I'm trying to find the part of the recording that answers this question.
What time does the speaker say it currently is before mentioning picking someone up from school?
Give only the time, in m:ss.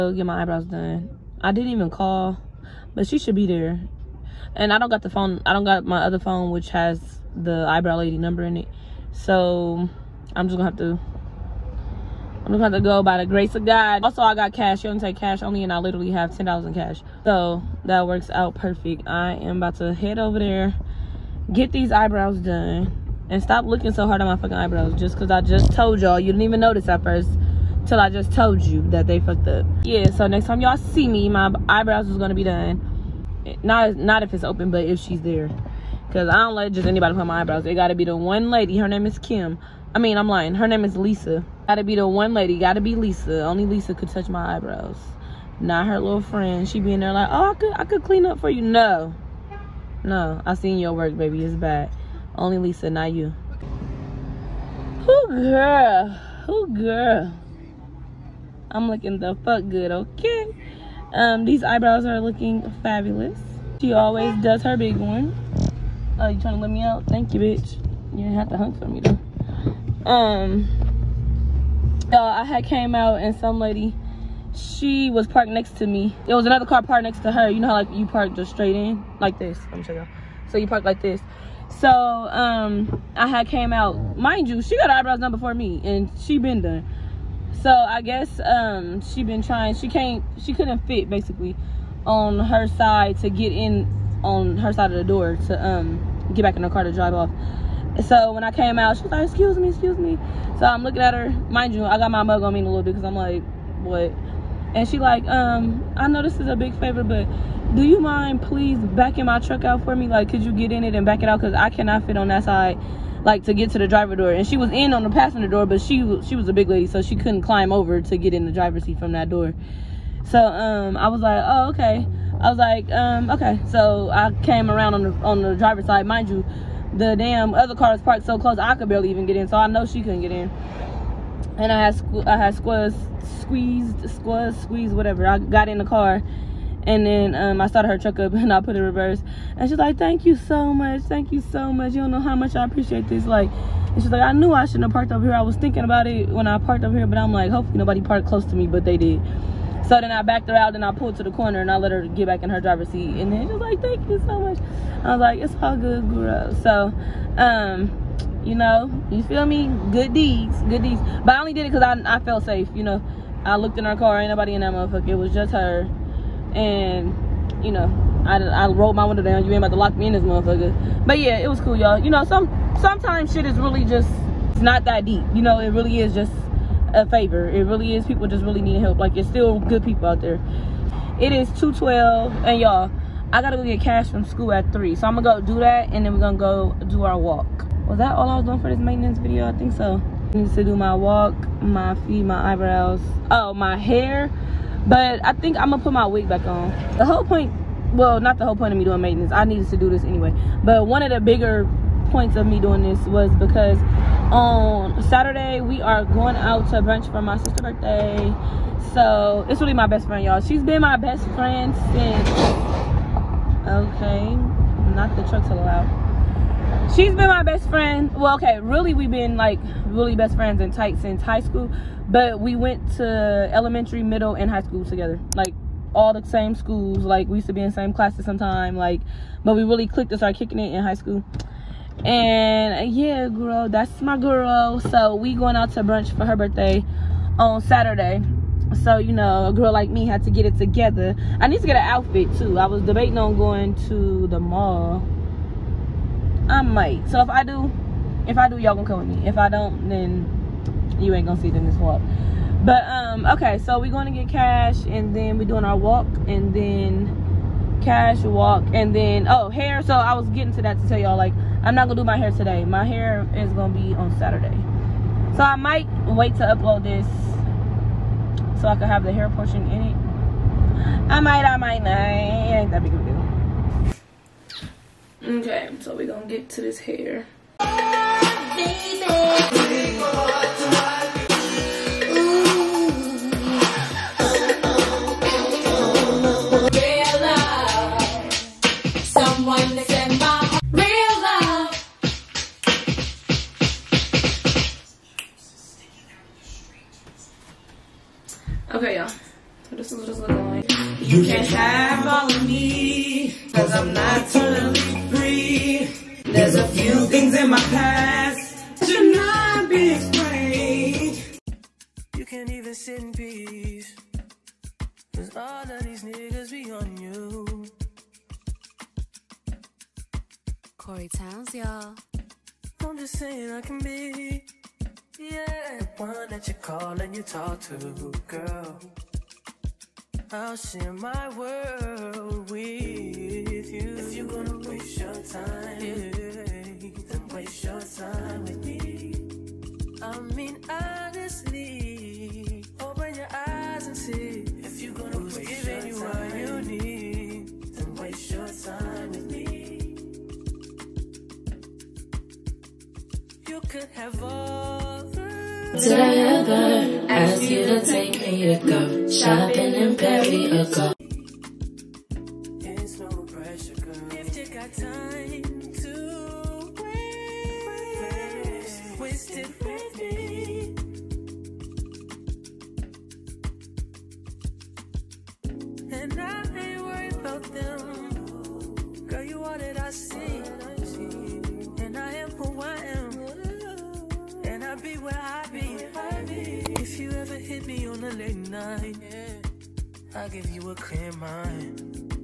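3:01.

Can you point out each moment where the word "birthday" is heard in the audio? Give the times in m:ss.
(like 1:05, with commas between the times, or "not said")
3:27, 3:56.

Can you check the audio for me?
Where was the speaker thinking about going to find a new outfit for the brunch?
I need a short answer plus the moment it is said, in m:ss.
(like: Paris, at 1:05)
the mall, at 4:04.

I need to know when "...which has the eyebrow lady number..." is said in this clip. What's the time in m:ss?
0:06.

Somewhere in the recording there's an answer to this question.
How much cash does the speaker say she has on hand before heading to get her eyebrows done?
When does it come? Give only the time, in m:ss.
0:16.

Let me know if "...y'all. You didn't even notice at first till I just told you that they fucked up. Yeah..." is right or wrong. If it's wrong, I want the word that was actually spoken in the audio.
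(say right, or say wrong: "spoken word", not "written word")
right.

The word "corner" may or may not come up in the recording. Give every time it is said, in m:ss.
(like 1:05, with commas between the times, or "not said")
2:31.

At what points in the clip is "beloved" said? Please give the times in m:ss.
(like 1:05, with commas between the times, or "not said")
not said.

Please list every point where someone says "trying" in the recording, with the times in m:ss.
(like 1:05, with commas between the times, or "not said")
1:06, 1:29.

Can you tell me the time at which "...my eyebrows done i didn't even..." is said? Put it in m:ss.
0:00.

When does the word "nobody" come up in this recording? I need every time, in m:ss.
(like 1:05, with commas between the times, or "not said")
2:27, 2:44.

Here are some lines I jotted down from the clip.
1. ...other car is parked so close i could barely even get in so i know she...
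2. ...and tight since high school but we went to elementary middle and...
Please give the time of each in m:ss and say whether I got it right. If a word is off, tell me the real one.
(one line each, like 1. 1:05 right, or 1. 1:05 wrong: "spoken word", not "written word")
1. 2:07 right
2. 3:40 right.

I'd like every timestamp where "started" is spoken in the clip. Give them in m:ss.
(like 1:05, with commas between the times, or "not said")
2:17, 3:50.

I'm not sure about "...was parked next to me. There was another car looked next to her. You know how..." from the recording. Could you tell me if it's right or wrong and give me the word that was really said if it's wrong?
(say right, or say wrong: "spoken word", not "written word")
wrong: "parked", not "looked".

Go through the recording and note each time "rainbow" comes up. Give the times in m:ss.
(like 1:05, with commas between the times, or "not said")
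not said.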